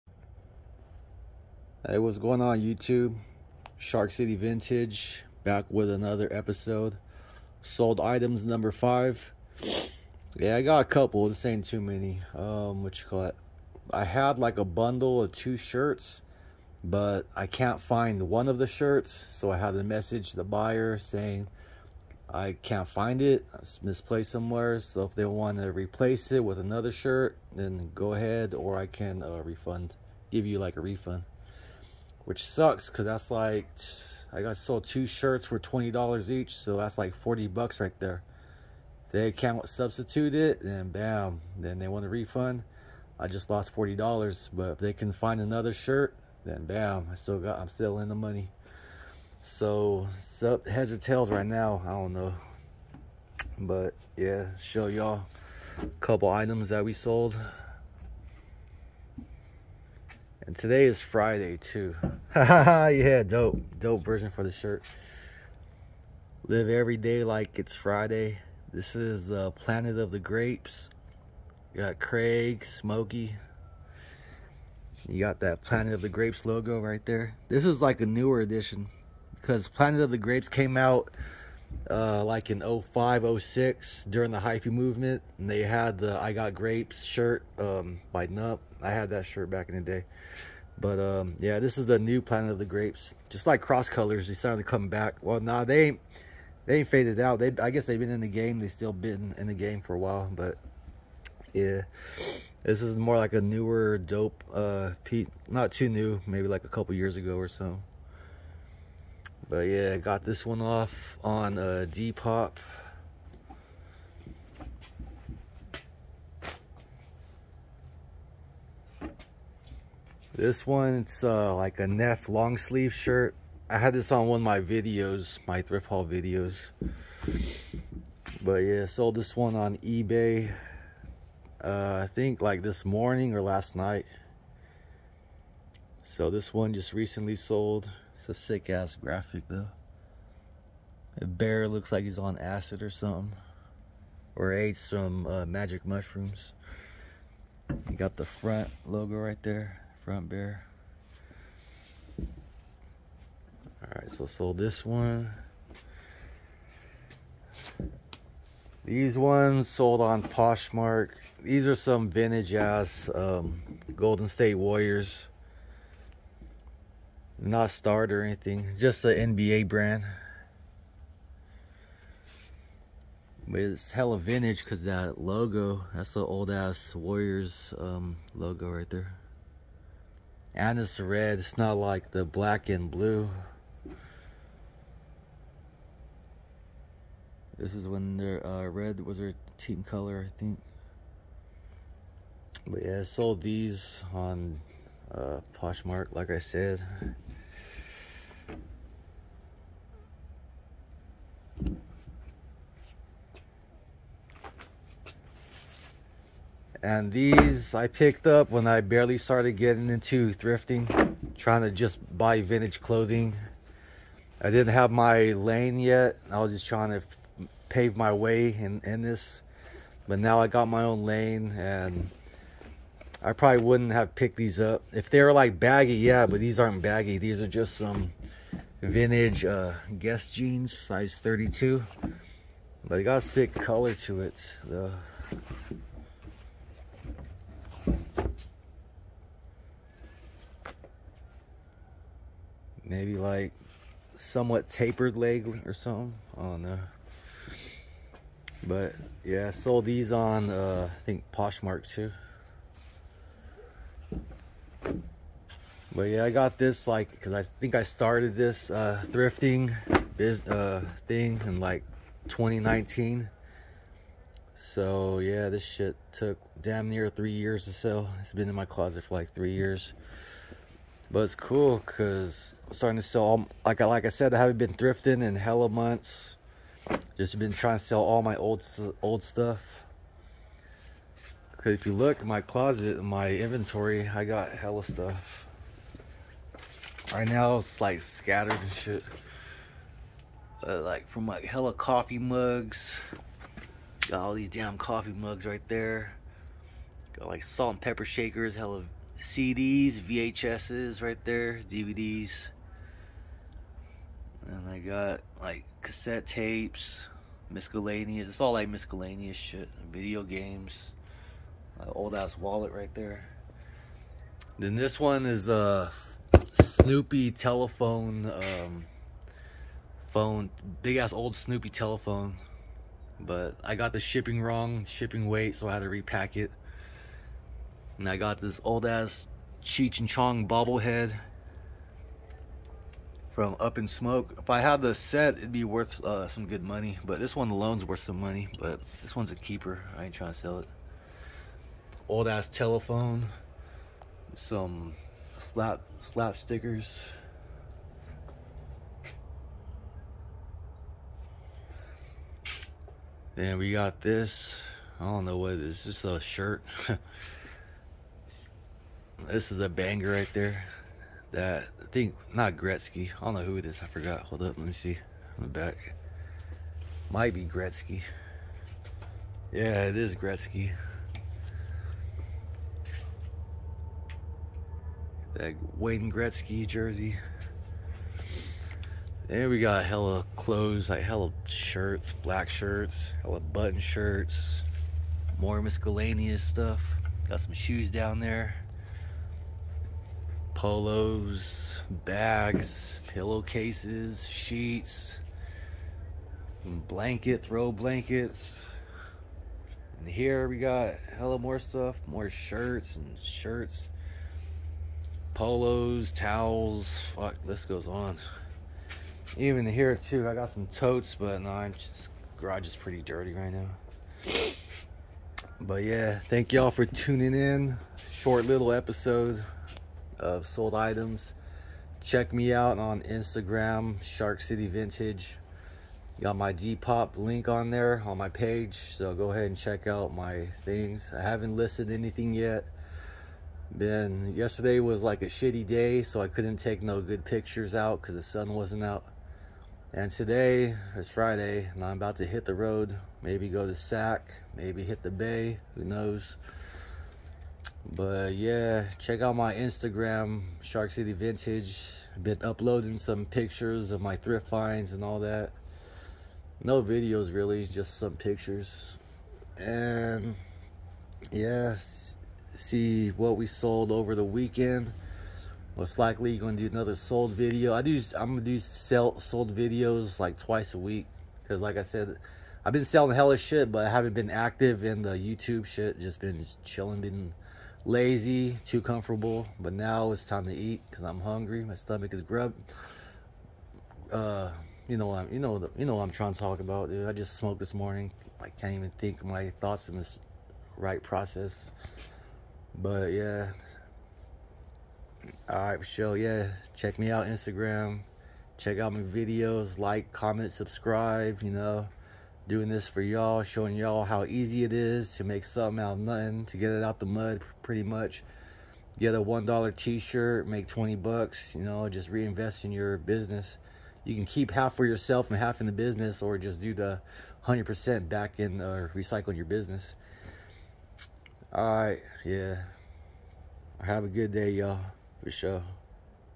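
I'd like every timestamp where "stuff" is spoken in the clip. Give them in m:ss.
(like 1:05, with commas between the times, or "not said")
4:39, 4:44, 6:26, 6:41.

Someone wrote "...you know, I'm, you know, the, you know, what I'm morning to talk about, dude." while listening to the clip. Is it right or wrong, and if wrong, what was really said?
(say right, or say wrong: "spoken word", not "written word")
wrong: "trying", not "morning".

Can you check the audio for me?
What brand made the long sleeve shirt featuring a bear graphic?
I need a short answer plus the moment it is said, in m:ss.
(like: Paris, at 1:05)
Neff, at 2:01.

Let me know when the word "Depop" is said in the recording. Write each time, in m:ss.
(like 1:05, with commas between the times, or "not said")
1:51, 7:06.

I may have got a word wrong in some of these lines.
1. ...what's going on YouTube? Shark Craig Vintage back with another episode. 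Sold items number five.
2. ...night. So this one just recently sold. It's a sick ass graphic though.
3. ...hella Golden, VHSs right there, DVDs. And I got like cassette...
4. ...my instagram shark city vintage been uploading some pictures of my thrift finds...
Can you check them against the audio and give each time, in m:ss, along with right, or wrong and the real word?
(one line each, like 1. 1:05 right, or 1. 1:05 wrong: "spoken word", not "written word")
1. 0:01 wrong: "City", not "Craig"
2. 2:13 right
3. 4:58 wrong: "CDs", not "Golden"
4. 7:29 right.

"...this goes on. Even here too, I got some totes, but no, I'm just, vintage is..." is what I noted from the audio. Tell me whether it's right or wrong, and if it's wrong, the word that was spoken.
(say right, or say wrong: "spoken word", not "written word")
wrong: "garage", not "vintage".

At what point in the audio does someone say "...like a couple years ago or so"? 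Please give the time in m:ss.
1:46.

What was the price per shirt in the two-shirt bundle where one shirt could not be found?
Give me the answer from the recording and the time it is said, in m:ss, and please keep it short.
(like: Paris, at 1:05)
$20, at 0:35.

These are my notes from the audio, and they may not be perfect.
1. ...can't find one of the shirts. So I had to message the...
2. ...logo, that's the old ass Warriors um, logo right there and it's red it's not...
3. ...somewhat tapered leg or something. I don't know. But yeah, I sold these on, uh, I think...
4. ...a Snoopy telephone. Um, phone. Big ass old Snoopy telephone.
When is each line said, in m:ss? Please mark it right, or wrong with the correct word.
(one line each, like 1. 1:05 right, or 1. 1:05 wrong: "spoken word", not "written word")
1. 0:17 right
2. 2:55 right
3. 4:04 right
4. 5:15 right.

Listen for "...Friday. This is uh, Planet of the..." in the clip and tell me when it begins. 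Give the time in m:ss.
1:07.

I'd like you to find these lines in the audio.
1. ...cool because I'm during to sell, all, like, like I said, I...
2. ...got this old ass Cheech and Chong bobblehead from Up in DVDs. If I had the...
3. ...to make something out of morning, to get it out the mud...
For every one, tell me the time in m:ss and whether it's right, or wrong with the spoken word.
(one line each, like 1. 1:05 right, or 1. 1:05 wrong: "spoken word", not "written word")
1. 4:31 wrong: "starting", not "during"
2. 5:28 wrong: "Smoke", not "DVDs"
3. 8:25 wrong: "nothing", not "morning".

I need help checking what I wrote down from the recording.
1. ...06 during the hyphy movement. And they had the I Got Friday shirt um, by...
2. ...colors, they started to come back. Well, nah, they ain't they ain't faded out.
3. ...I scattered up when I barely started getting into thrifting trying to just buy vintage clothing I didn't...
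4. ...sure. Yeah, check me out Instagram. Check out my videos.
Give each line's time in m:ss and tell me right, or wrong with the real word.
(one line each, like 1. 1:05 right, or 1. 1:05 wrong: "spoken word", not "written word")
1. 1:23 wrong: "Grapes", not "Friday"
2. 1:33 right
3. 3:27 wrong: "picked", not "scattered"
4. 8:15 right.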